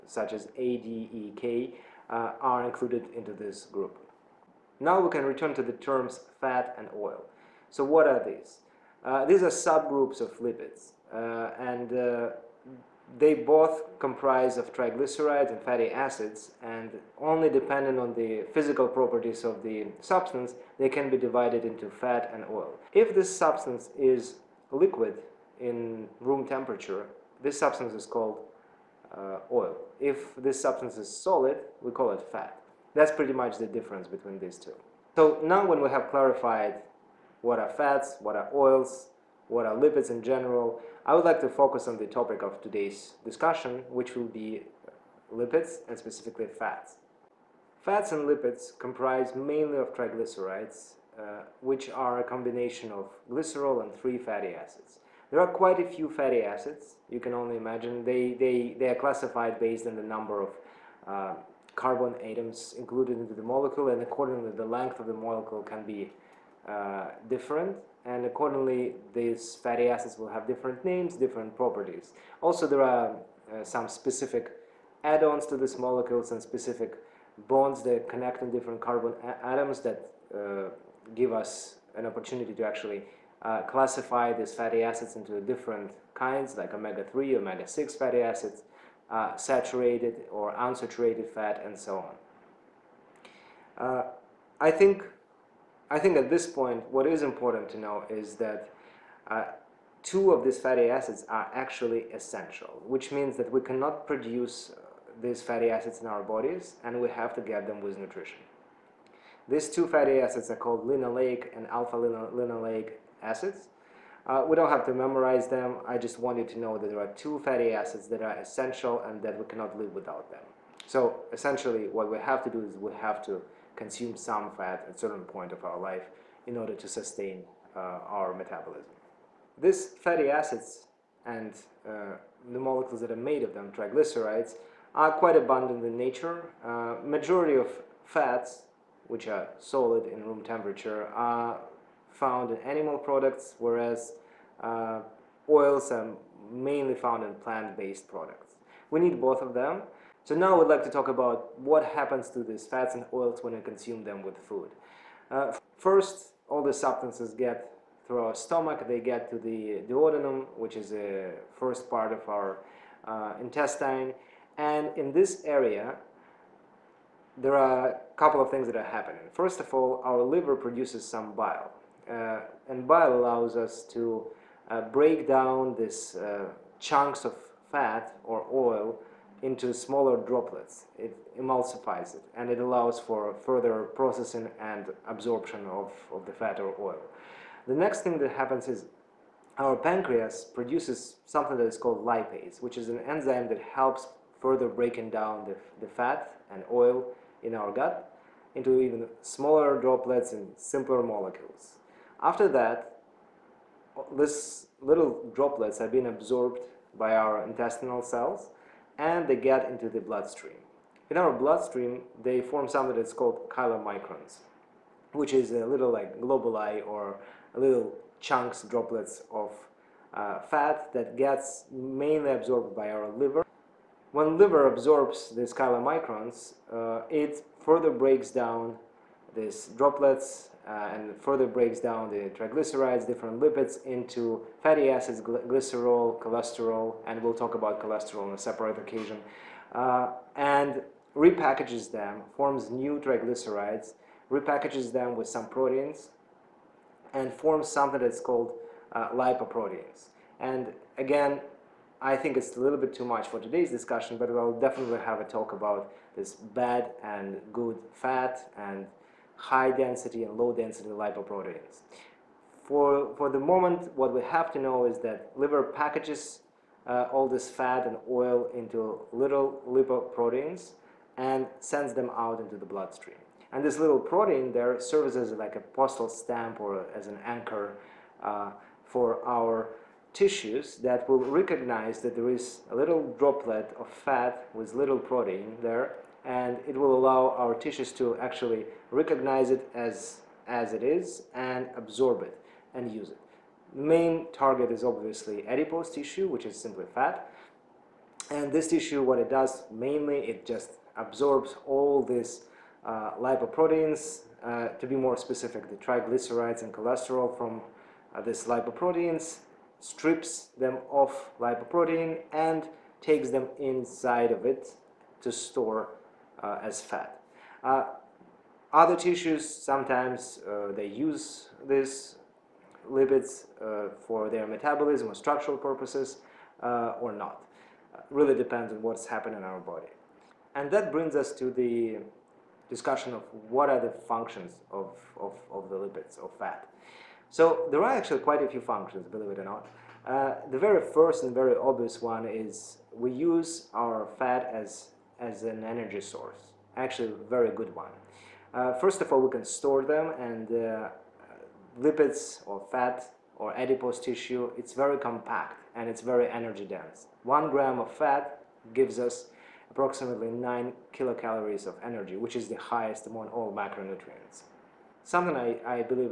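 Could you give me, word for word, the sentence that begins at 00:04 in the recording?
Now we can return to the terms fat and oil.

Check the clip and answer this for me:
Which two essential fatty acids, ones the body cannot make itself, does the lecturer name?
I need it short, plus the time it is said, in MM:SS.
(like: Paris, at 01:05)
linoleic and alpha linolenic, at 01:50.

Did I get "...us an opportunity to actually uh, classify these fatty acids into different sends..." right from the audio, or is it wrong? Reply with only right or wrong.
wrong.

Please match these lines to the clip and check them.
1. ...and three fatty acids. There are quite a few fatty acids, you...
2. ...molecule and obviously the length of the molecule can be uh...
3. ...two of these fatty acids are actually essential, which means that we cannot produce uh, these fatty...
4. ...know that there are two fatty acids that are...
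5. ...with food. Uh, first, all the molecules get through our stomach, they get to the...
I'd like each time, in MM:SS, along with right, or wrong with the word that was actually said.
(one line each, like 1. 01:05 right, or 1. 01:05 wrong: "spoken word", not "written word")
1. 00:53 right
2. 01:03 wrong: "accordingly", not "obviously"
3. 01:40 right
4. 01:56 right
5. 02:34 wrong: "substances", not "molecules".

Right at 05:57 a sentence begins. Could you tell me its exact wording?
One gram of fat gives us approximately 9 kilocalories of energy, which is the highest among all macronutrients.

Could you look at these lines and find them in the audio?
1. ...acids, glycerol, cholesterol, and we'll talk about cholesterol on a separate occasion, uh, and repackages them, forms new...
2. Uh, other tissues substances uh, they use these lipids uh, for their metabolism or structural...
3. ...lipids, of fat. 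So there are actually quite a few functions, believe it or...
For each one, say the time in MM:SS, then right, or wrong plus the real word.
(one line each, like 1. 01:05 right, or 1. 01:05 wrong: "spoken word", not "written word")
1. 03:54 right
2. 05:17 wrong: "sometimes", not "substances"
3. 05:35 right.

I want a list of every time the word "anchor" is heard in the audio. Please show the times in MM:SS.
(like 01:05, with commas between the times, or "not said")
04:37.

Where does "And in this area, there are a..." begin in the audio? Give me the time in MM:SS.
02:44.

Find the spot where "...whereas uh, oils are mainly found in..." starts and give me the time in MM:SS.
02:23.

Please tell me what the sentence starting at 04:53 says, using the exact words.
Main target is obviously adipose tissue, which is simply fat.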